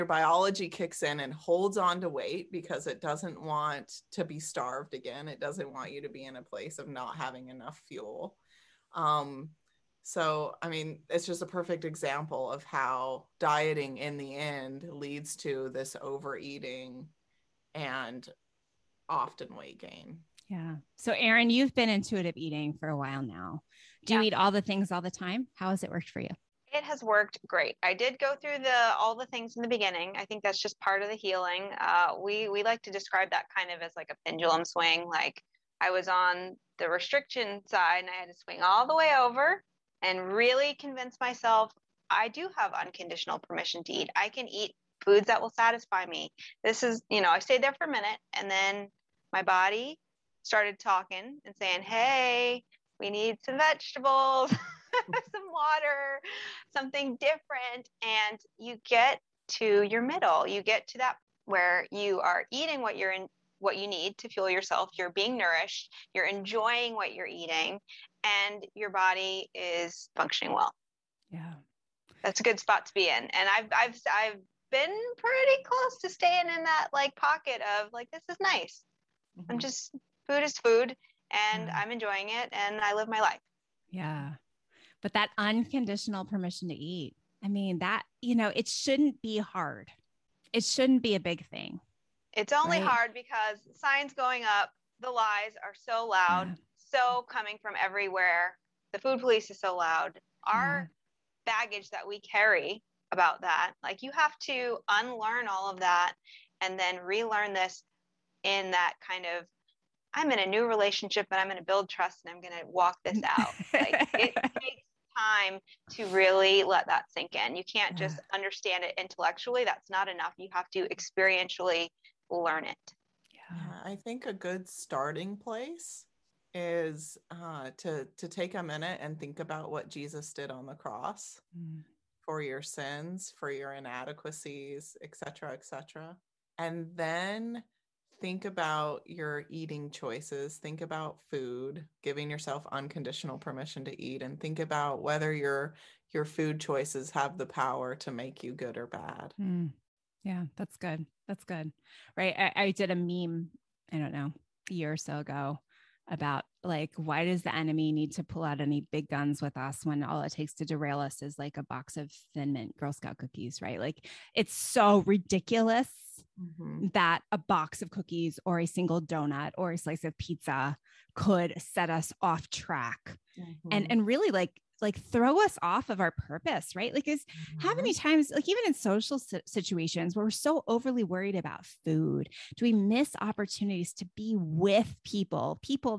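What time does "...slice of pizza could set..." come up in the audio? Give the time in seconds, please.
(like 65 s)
169 s.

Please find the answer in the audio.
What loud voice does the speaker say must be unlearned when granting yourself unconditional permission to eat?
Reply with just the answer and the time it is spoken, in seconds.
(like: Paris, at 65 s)
The food police, at 98 s.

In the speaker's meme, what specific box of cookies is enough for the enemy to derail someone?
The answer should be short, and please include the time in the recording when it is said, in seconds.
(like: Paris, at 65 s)
Thin Mint Girl Scout cookies, at 162 s.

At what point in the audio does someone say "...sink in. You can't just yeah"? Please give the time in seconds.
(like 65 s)
117 s.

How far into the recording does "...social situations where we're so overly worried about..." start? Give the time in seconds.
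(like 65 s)
178 s.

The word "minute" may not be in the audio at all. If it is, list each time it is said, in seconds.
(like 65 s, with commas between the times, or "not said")
47 s, 128 s.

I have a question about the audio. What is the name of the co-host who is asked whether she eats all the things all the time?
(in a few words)
Erin.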